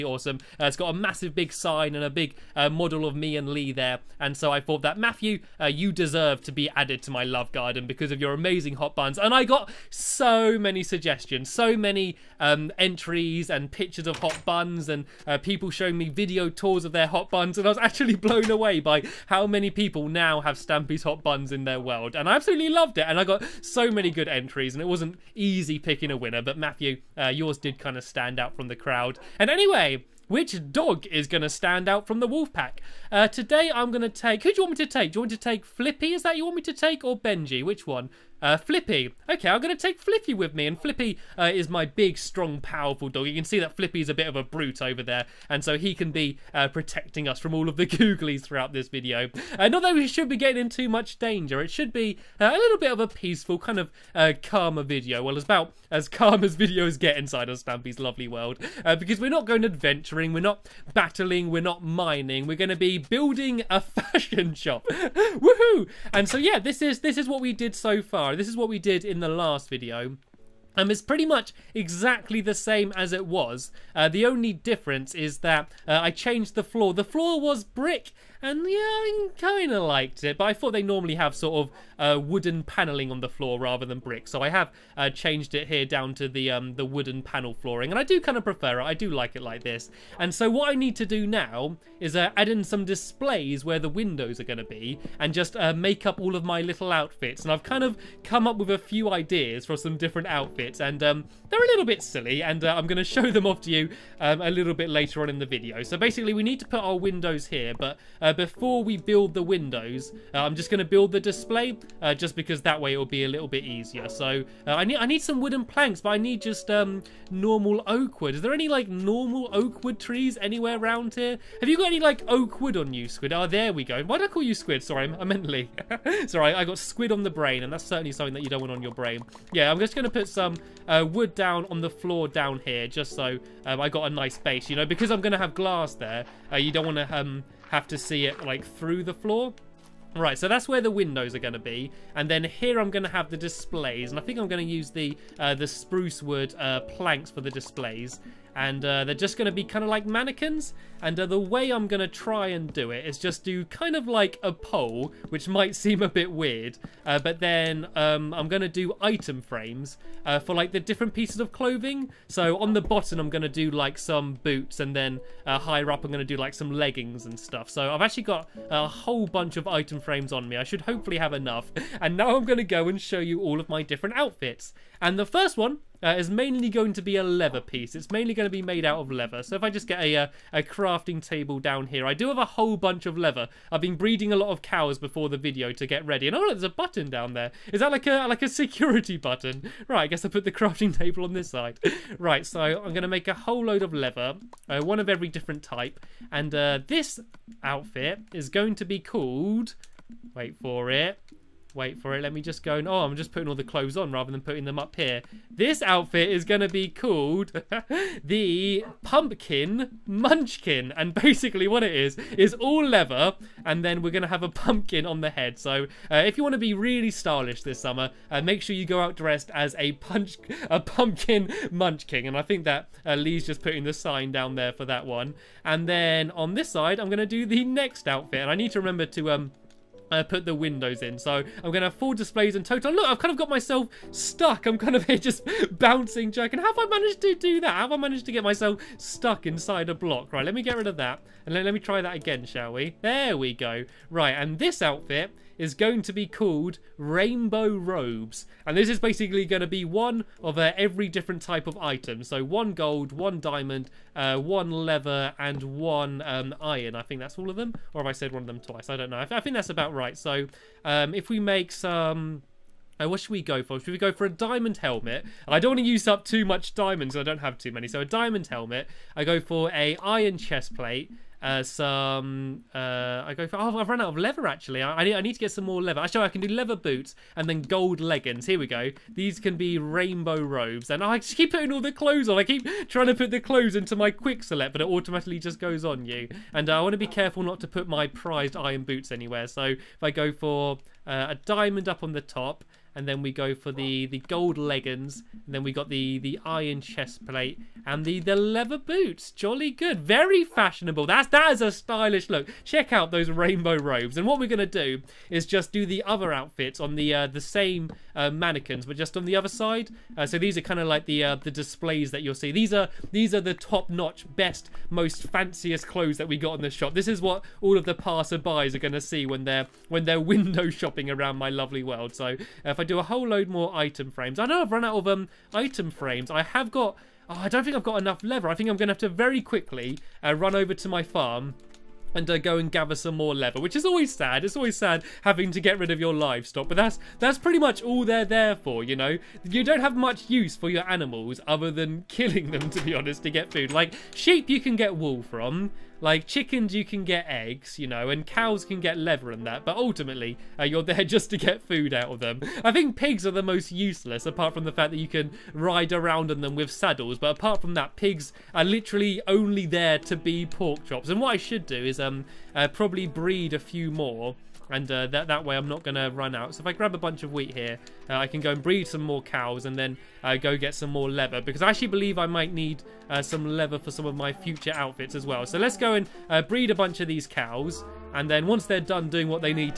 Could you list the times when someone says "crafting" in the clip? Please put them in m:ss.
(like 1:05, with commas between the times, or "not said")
3:00, 3:10.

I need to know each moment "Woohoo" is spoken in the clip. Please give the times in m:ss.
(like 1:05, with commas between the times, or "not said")
1:04.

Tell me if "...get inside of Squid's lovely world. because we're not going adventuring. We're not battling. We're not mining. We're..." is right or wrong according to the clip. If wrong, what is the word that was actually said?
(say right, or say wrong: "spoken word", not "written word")
wrong: "Stampy", not "Squid".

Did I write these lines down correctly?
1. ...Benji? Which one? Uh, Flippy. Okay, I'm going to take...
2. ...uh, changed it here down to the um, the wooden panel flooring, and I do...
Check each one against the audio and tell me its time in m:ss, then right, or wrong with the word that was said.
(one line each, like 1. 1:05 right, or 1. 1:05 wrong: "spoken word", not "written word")
1. 0:37 right
2. 1:24 right.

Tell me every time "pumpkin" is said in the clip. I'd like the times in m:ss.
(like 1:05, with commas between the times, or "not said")
3:29, 3:34, 3:40.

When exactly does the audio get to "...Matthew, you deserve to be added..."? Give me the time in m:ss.
0:04.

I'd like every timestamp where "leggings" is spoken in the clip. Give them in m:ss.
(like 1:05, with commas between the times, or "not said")
2:46, 4:37, 4:54.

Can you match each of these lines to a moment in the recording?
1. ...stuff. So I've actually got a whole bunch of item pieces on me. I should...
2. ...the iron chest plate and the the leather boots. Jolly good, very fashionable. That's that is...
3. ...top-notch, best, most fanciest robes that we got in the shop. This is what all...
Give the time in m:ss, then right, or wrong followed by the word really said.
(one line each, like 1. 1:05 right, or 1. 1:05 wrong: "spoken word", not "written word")
1. 2:47 wrong: "frames", not "pieces"
2. 4:56 right
3. 5:13 wrong: "clothes", not "robes".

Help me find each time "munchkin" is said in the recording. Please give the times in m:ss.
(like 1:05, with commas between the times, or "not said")
3:30, 3:41.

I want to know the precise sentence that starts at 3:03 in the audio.
I've been breeding a lot of cows before the video to get ready.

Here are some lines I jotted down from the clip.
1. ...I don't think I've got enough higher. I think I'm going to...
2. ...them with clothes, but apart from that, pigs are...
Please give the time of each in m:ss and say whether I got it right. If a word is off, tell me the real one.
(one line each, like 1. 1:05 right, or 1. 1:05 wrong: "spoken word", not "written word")
1. 5:27 wrong: "leather", not "higher"
2. 5:56 wrong: "saddles", not "clothes".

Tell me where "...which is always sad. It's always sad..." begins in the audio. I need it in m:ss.
5:33.